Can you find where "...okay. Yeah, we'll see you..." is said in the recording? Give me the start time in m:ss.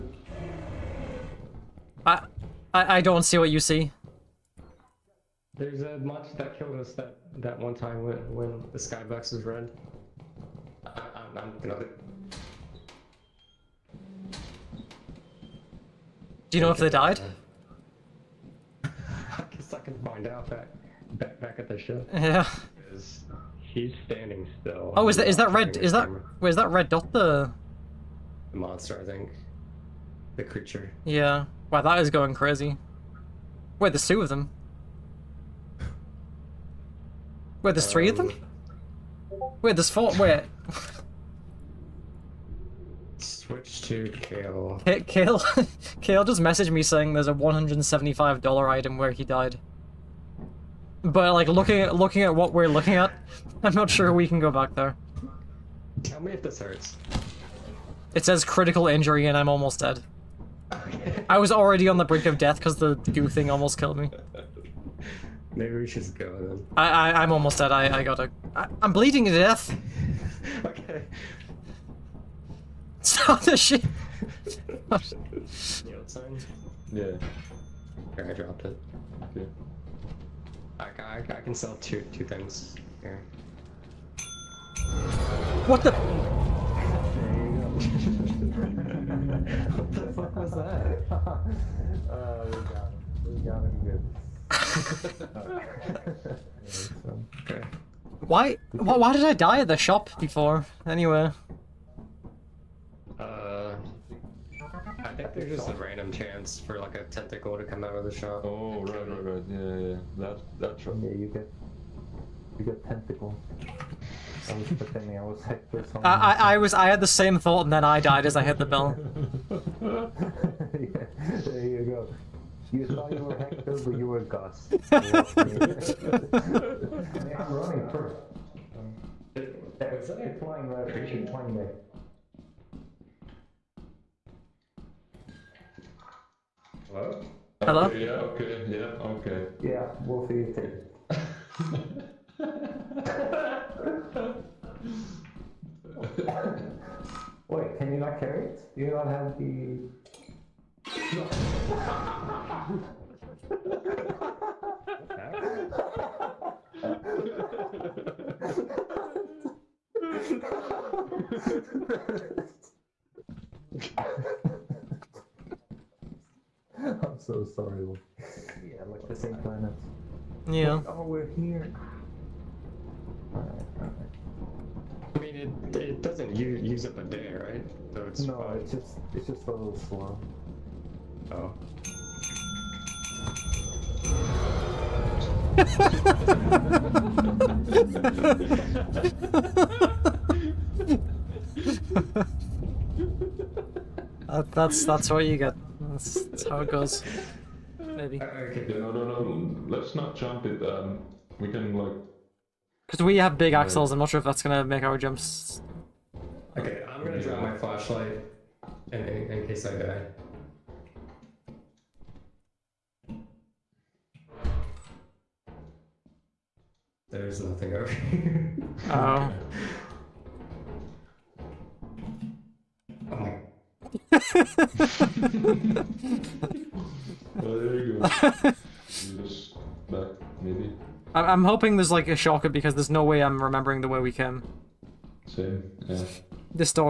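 2:19.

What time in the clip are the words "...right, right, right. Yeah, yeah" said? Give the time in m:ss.
1:48.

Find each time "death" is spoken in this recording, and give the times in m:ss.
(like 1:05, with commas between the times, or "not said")
1:02, 1:09.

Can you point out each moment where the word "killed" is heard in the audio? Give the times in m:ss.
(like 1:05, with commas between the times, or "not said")
0:06, 1:03.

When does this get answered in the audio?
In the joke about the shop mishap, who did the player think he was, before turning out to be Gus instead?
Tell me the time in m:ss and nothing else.
2:03.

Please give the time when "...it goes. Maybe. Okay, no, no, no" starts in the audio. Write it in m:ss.
3:16.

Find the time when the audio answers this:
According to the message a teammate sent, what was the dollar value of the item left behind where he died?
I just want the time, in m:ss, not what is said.
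0:47.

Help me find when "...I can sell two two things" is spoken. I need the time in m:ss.
1:21.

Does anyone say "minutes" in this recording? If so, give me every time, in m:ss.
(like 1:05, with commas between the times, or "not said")
2:11.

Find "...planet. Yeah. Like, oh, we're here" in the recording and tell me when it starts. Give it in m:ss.
2:49.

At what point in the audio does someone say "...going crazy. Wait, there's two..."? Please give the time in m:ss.
0:32.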